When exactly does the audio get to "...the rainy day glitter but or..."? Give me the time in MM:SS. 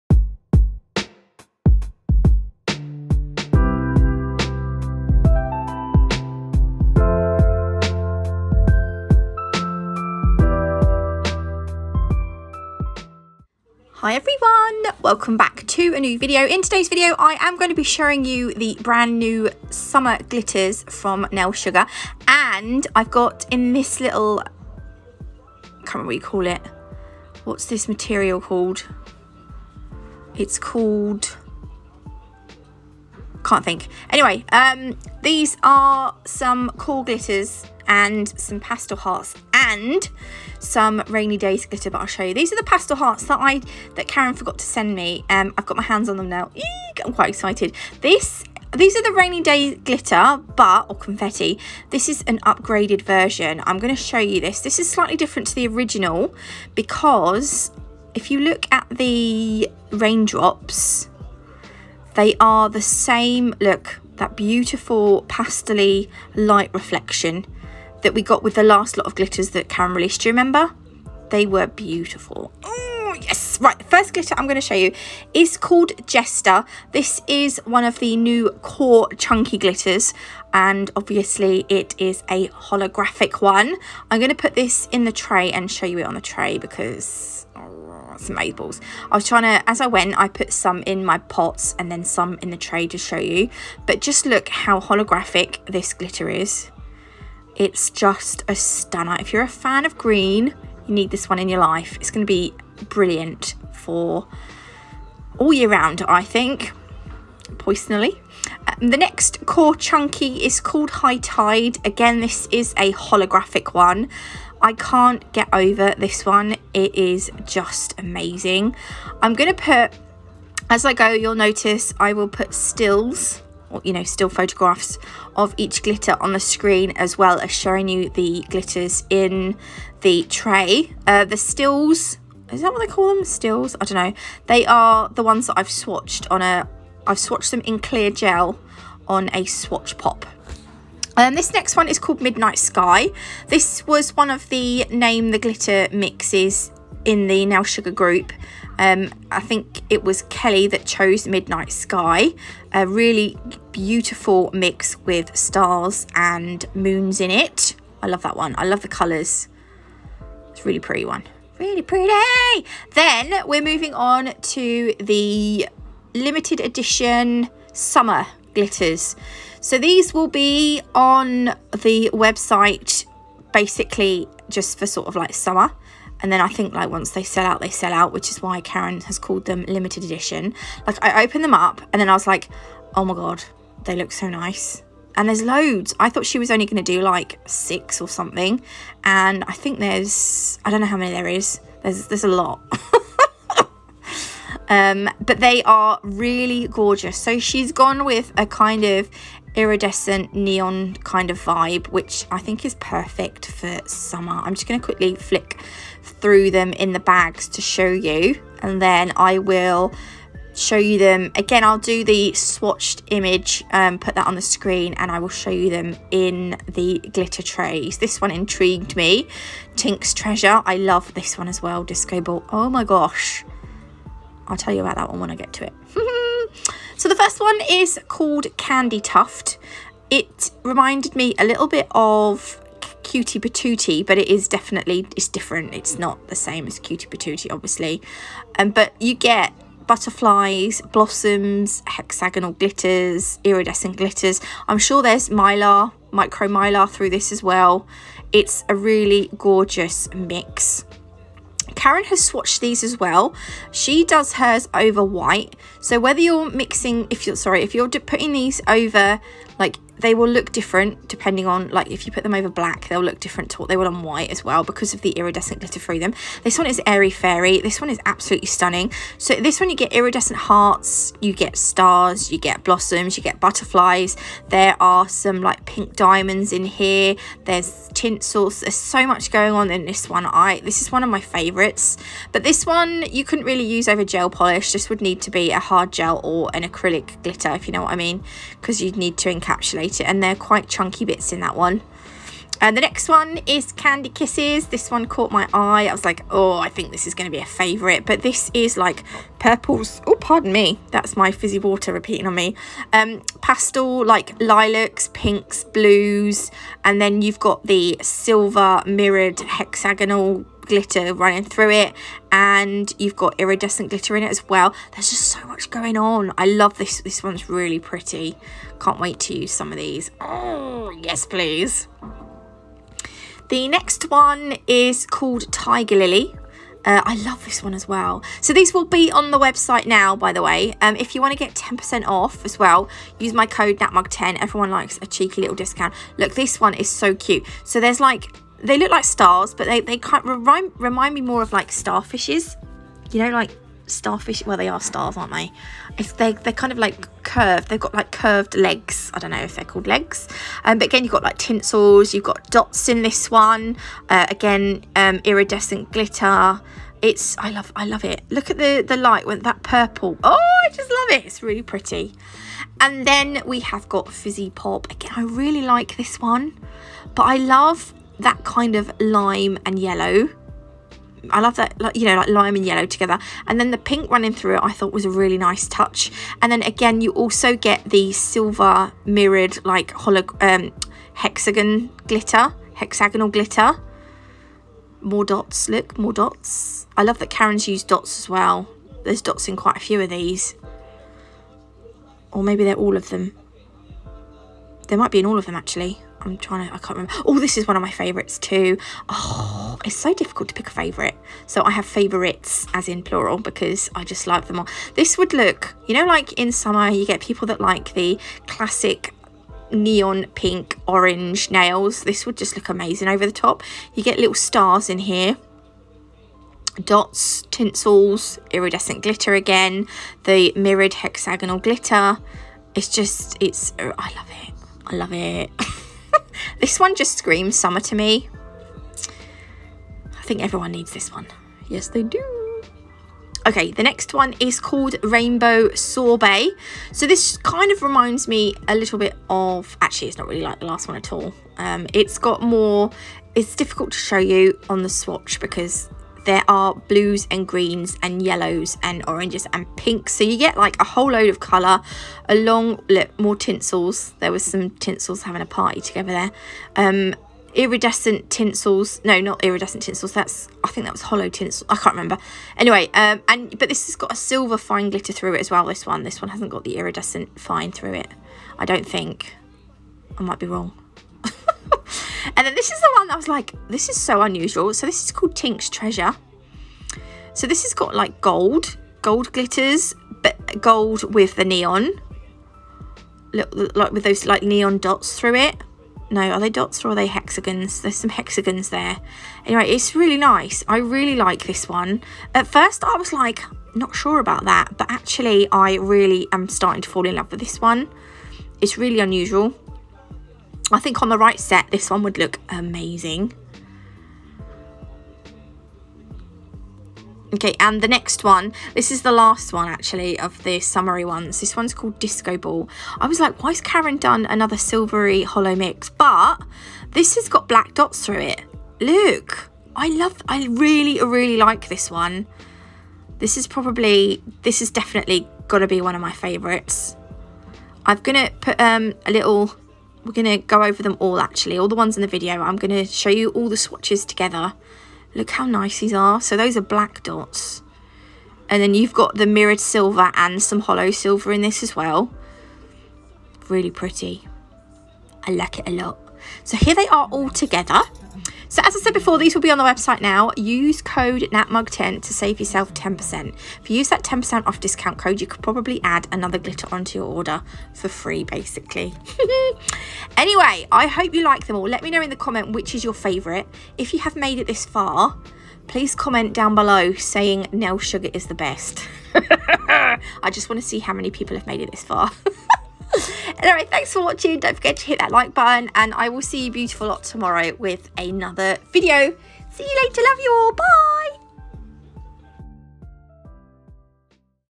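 00:49.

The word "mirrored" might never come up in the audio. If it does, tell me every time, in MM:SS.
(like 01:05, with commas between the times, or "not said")
05:08, 06:19, 07:00, 08:59.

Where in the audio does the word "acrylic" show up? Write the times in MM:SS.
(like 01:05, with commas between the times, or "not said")
04:46.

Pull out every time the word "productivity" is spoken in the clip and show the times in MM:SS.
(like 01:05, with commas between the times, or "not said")
not said.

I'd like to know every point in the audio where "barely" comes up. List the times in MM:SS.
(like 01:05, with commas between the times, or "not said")
not said.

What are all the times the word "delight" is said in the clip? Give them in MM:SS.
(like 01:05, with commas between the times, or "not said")
not said.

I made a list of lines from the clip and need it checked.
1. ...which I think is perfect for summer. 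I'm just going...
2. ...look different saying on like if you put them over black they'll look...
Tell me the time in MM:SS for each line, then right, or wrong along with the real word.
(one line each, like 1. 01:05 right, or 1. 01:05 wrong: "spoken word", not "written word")
1. 03:21 right
2. 04:20 wrong: "depending", not "saying".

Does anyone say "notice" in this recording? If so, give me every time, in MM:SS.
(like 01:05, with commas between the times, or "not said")
02:01.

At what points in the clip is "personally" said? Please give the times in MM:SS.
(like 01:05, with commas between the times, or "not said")
01:47.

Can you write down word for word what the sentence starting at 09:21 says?
Let me know in the comment which is your favourite.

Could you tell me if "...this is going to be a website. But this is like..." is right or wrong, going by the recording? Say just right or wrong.
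wrong.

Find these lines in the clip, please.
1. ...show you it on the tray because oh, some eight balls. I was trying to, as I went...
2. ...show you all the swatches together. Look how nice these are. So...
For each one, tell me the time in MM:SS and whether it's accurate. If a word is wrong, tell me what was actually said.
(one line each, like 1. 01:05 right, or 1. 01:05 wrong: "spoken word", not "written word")
1. 01:25 right
2. 08:52 right.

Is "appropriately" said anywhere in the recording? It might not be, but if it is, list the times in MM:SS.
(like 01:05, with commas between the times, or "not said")
not said.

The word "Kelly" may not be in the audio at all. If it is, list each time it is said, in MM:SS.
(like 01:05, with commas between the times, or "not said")
02:30.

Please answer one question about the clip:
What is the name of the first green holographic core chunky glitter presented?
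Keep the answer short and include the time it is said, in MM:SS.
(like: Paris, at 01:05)
Jester, at 01:16.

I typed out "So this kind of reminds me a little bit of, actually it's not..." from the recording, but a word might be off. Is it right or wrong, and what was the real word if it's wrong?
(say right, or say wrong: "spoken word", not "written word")
right.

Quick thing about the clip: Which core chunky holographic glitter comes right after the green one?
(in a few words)
High Tide.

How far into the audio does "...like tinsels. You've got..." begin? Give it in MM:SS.
05:51.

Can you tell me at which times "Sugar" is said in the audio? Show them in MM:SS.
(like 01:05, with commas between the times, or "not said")
00:21, 02:27, 09:27.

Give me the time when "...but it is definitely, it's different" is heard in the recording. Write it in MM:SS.
03:54.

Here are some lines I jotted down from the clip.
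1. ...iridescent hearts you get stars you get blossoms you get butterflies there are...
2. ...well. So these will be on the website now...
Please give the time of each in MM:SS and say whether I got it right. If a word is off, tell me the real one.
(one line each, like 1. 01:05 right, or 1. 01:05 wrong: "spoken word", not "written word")
1. 04:29 right
2. 05:27 right.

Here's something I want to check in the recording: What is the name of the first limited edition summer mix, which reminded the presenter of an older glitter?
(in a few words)
Candy Tuft.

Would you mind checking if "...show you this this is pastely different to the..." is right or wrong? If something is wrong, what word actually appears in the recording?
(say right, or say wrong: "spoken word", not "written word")
wrong: "slightly", not "pastely".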